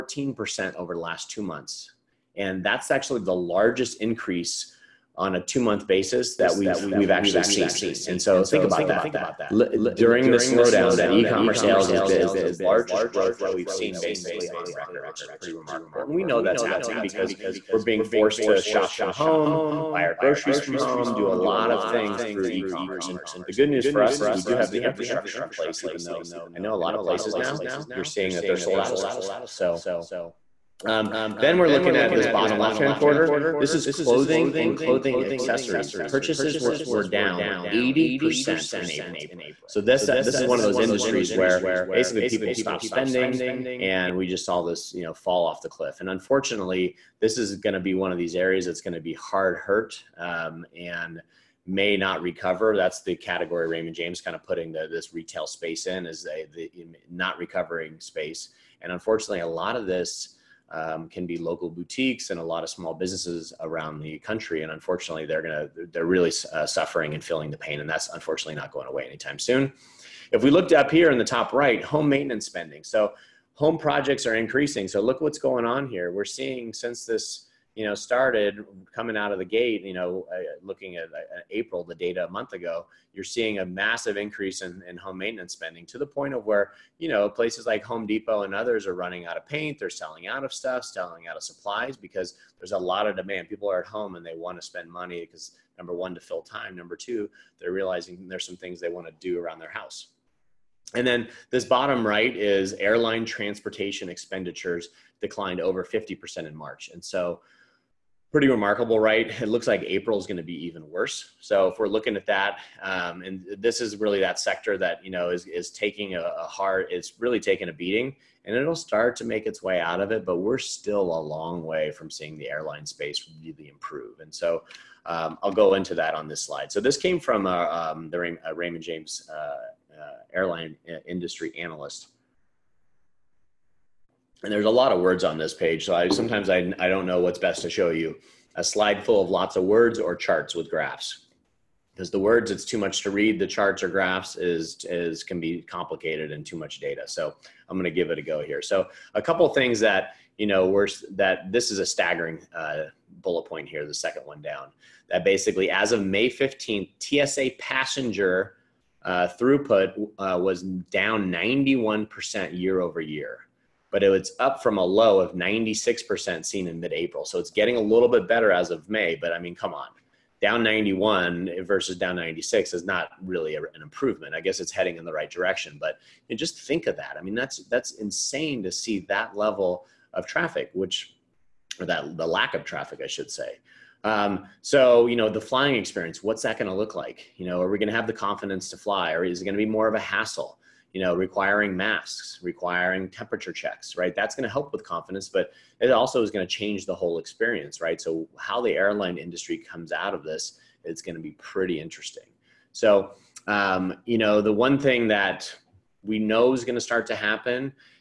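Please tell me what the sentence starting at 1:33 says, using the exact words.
People are at home and they want to spend money because number one, to fill time.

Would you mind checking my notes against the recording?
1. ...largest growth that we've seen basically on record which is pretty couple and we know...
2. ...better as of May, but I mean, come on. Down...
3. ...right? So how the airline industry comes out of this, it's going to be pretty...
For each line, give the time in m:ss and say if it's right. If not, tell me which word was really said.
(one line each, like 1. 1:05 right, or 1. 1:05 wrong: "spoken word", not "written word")
1. 0:12 wrong: "remarkable", not "couple"
2. 2:48 right
3. 3:17 right.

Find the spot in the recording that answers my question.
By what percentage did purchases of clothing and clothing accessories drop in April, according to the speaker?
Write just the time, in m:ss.
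0:37.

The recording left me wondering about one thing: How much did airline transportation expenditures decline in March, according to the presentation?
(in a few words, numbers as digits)
over 50%.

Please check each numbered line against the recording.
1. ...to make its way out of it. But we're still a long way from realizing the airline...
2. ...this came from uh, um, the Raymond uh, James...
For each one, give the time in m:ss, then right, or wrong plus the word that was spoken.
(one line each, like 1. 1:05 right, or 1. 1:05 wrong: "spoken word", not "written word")
1. 1:59 wrong: "seeing", not "realizing"
2. 2:06 right.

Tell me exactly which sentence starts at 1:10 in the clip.
If we looked up here in the top right, home maintenance spending.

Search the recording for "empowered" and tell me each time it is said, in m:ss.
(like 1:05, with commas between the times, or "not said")
not said.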